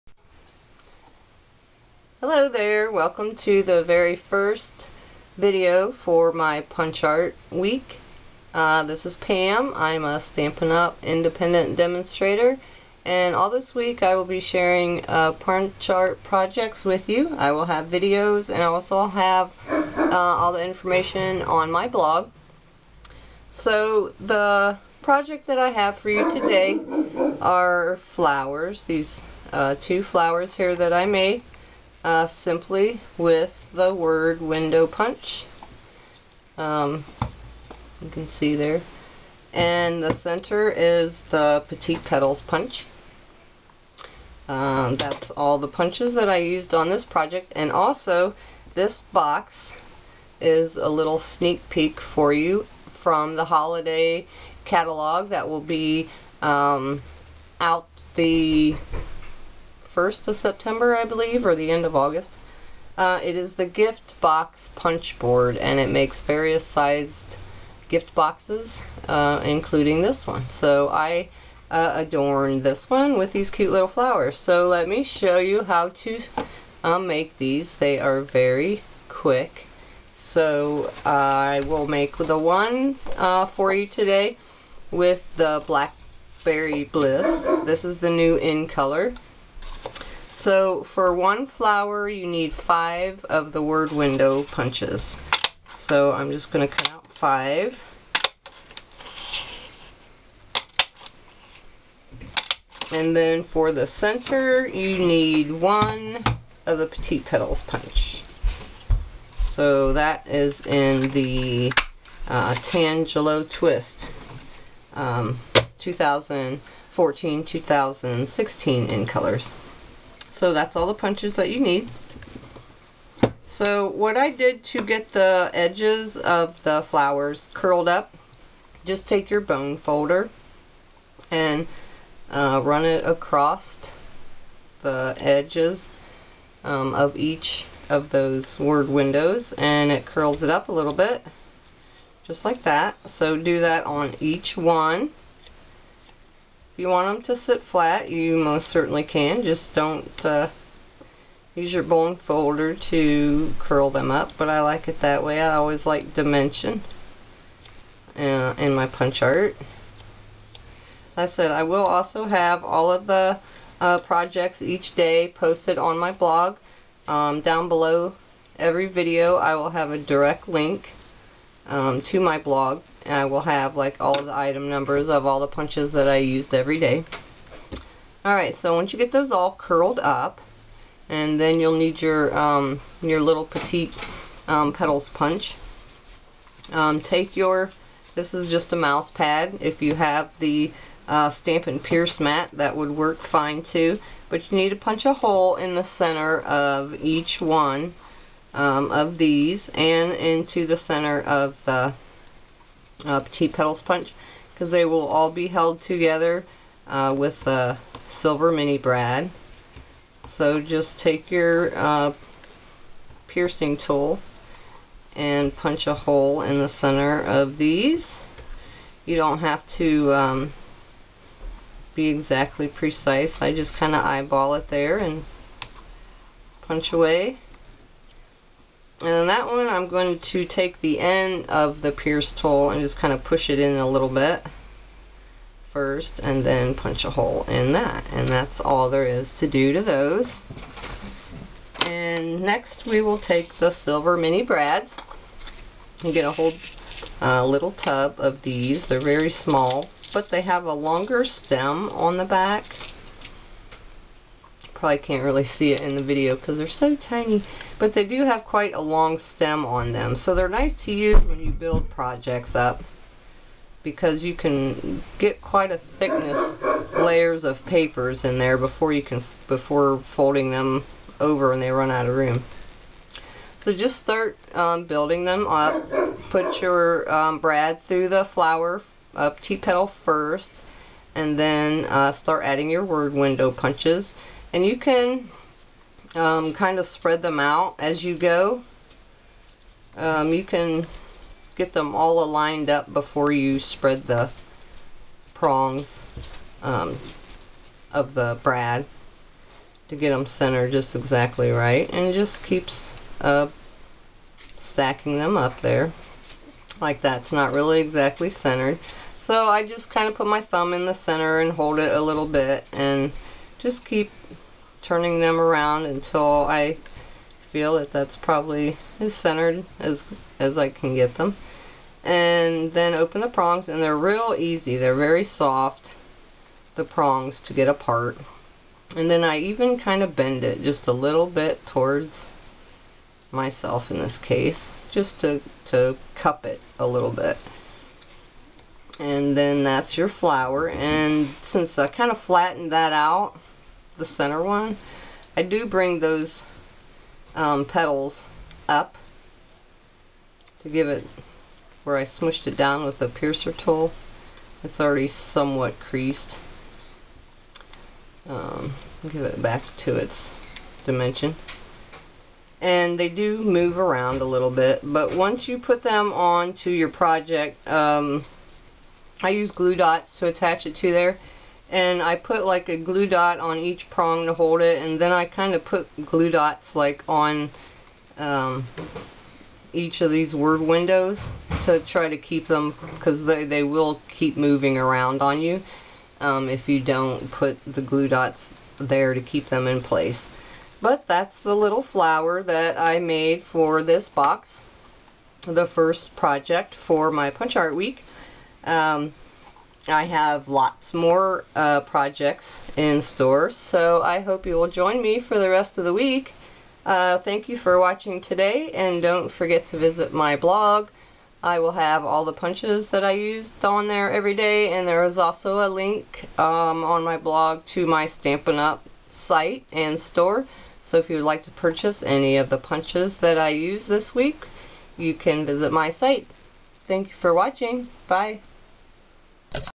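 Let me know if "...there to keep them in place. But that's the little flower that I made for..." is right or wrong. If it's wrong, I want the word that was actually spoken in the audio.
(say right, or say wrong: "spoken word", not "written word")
right.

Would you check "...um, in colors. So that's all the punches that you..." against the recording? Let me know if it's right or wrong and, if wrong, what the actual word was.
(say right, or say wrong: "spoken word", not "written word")
right.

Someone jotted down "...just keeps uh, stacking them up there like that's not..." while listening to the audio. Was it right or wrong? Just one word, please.
right.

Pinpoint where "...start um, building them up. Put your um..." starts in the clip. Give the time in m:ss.
4:33.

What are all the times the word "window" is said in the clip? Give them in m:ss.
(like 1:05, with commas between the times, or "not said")
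0:34, 1:33, 2:18, 4:43, 6:20.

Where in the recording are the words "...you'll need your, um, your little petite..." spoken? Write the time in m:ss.
3:01.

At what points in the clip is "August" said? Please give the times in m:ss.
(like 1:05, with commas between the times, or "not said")
1:01.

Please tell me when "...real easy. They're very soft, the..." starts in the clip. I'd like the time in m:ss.
5:23.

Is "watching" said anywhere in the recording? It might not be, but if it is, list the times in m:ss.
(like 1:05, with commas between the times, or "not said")
6:47, 7:07.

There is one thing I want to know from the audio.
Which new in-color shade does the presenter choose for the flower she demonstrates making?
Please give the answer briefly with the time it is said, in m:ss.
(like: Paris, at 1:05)
Blackberry Bliss, at 1:25.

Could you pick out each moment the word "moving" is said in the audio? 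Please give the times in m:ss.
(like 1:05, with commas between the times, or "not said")
6:24.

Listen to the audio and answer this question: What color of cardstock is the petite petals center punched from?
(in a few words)
Tangelo Twist.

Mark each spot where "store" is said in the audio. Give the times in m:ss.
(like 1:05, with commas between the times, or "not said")
6:43, 6:59.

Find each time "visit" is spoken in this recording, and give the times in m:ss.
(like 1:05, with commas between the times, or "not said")
6:49, 7:05.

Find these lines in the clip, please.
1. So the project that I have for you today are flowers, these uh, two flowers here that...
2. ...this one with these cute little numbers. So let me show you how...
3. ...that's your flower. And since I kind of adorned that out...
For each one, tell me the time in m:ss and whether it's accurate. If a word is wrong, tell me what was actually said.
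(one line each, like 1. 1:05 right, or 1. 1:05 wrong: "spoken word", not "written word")
1. 0:23 right
2. 1:12 wrong: "flowers", not "numbers"
3. 5:39 wrong: "flattened", not "adorned".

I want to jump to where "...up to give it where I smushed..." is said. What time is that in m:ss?
5:48.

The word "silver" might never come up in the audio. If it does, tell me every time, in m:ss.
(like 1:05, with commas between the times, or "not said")
3:28, 4:03.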